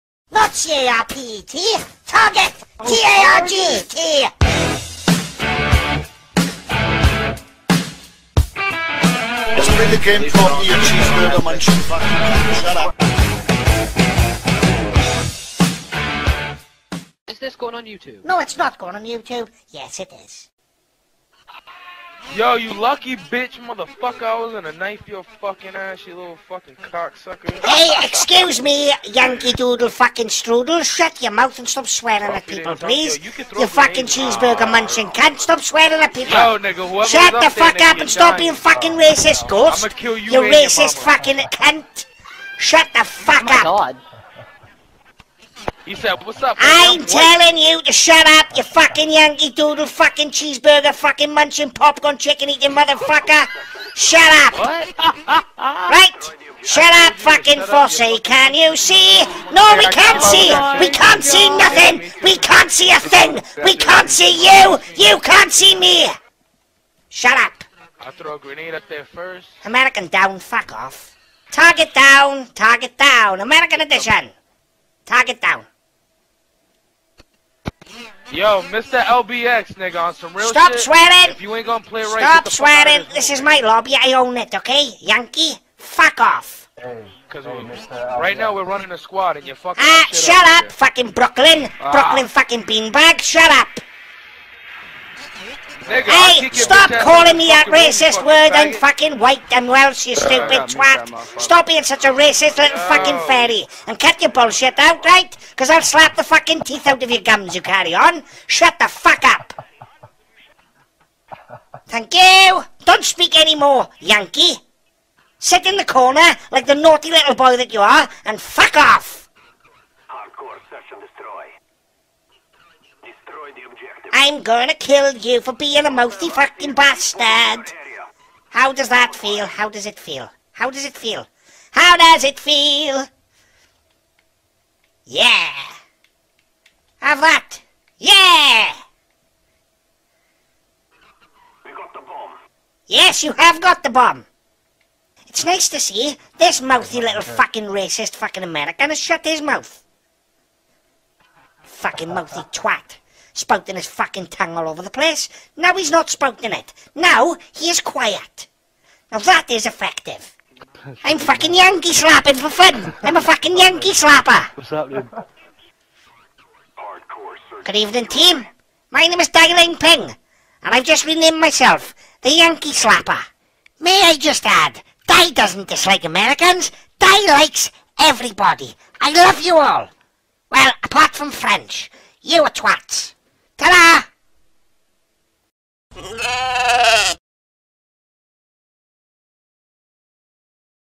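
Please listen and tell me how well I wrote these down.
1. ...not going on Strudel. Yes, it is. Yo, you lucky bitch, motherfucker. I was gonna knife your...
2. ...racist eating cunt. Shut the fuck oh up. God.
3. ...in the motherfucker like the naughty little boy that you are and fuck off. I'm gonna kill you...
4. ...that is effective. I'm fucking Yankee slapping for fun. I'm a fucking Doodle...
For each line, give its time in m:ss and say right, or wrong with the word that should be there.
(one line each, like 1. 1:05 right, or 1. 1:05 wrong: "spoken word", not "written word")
1. 0:18 wrong: "YouTube", not "Strudel"
2. 0:40 wrong: "fucking", not "eating"
3. 1:55 wrong: "corner", not "motherfucker"
4. 2:39 wrong: "Yankee", not "Doodle".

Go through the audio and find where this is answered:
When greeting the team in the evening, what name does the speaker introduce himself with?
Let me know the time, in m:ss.
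2:49.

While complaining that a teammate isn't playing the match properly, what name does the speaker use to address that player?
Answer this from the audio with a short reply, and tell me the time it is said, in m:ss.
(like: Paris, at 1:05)
Mr. LBX, at 1:18.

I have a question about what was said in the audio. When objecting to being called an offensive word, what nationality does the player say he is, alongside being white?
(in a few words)
Welsh.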